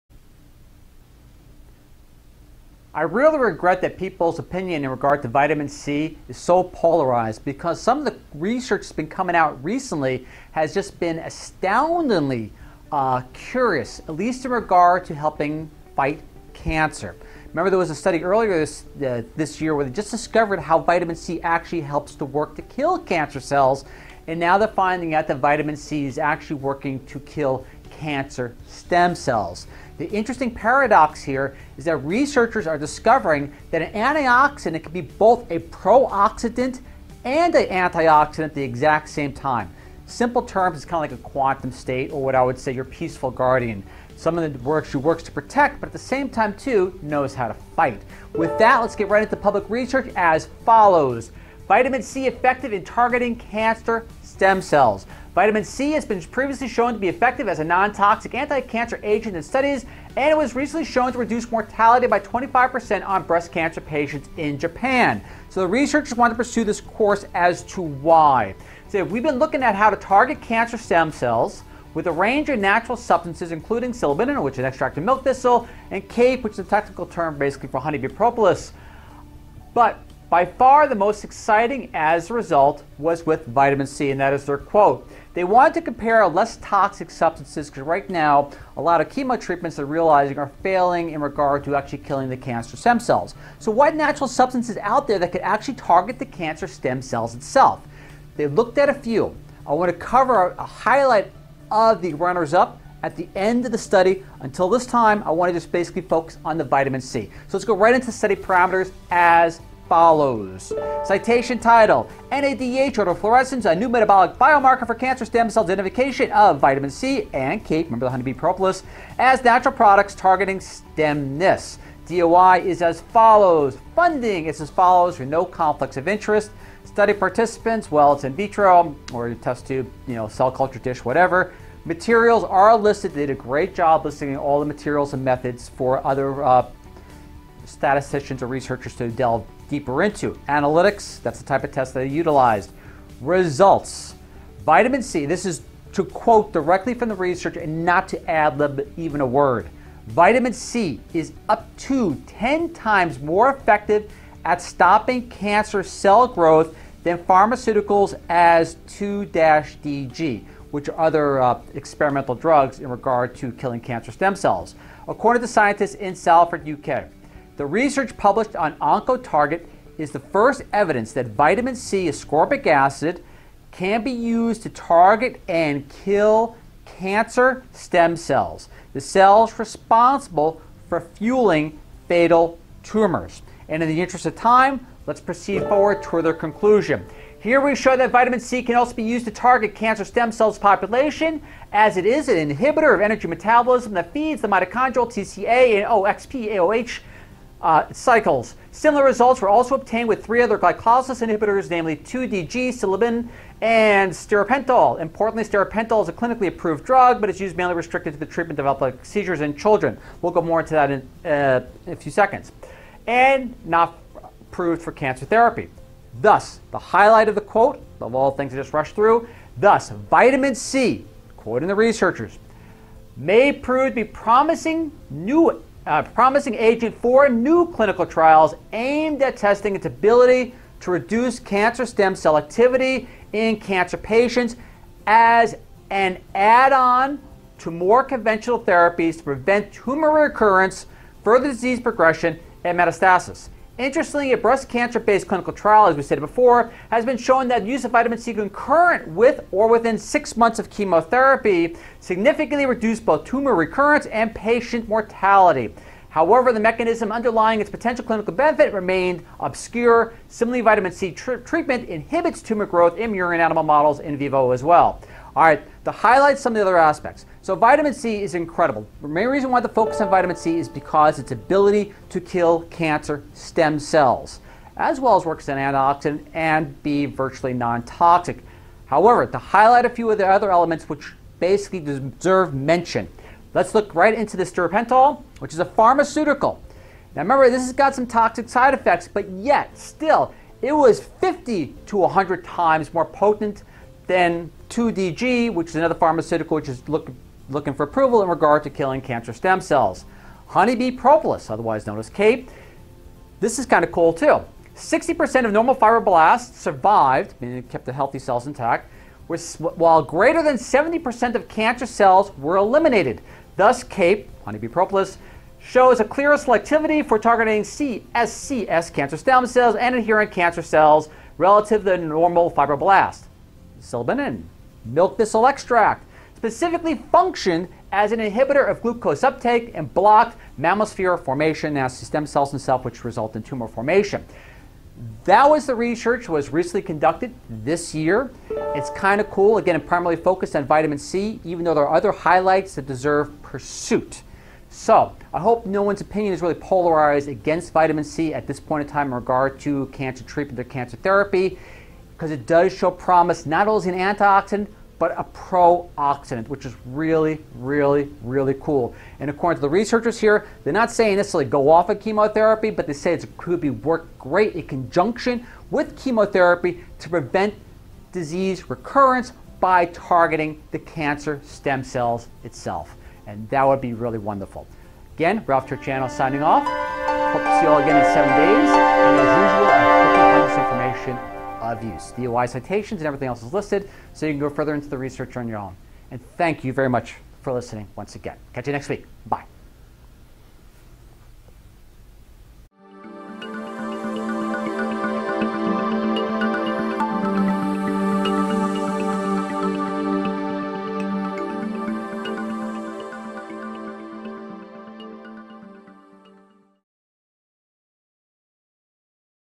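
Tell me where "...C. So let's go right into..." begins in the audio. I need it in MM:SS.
01:47.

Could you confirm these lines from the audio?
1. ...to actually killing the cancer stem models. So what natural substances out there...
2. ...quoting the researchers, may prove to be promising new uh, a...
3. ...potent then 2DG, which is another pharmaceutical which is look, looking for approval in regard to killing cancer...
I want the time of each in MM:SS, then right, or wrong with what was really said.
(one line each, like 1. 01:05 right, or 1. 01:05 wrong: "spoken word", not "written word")
1. 01:31 wrong: "cells", not "models"
2. 03:41 right
3. 04:53 right.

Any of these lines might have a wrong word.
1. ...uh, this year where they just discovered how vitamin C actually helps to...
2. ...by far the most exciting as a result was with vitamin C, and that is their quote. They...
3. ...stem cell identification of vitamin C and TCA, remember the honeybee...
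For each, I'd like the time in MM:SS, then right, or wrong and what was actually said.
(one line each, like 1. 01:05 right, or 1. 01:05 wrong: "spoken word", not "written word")
1. 00:19 right
2. 01:20 right
3. 01:55 wrong: "CAPE", not "TCA".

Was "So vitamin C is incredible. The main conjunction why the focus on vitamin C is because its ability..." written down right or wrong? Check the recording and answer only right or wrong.
wrong.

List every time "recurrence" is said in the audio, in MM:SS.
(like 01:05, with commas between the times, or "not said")
04:00, 04:13, 06:08.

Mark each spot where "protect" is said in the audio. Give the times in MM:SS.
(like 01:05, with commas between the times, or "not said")
00:45.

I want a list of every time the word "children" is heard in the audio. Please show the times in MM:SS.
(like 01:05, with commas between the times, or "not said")
03:29.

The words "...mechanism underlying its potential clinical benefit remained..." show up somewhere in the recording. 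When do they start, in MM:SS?
04:16.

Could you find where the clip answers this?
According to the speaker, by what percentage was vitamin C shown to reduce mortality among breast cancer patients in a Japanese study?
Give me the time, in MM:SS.
01:02.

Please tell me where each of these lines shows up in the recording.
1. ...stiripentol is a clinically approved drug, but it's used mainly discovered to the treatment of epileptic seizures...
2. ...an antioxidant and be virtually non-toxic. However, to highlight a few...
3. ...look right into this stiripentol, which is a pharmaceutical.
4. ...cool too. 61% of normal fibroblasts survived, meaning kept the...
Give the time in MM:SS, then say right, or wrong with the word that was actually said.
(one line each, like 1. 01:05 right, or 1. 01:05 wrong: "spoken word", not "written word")
1. 03:25 wrong: "restricted", not "discovered"
2. 04:35 right
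3. 04:43 right
4. 05:03 wrong: "60", not "61".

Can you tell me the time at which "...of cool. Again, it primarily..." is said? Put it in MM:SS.
05:39.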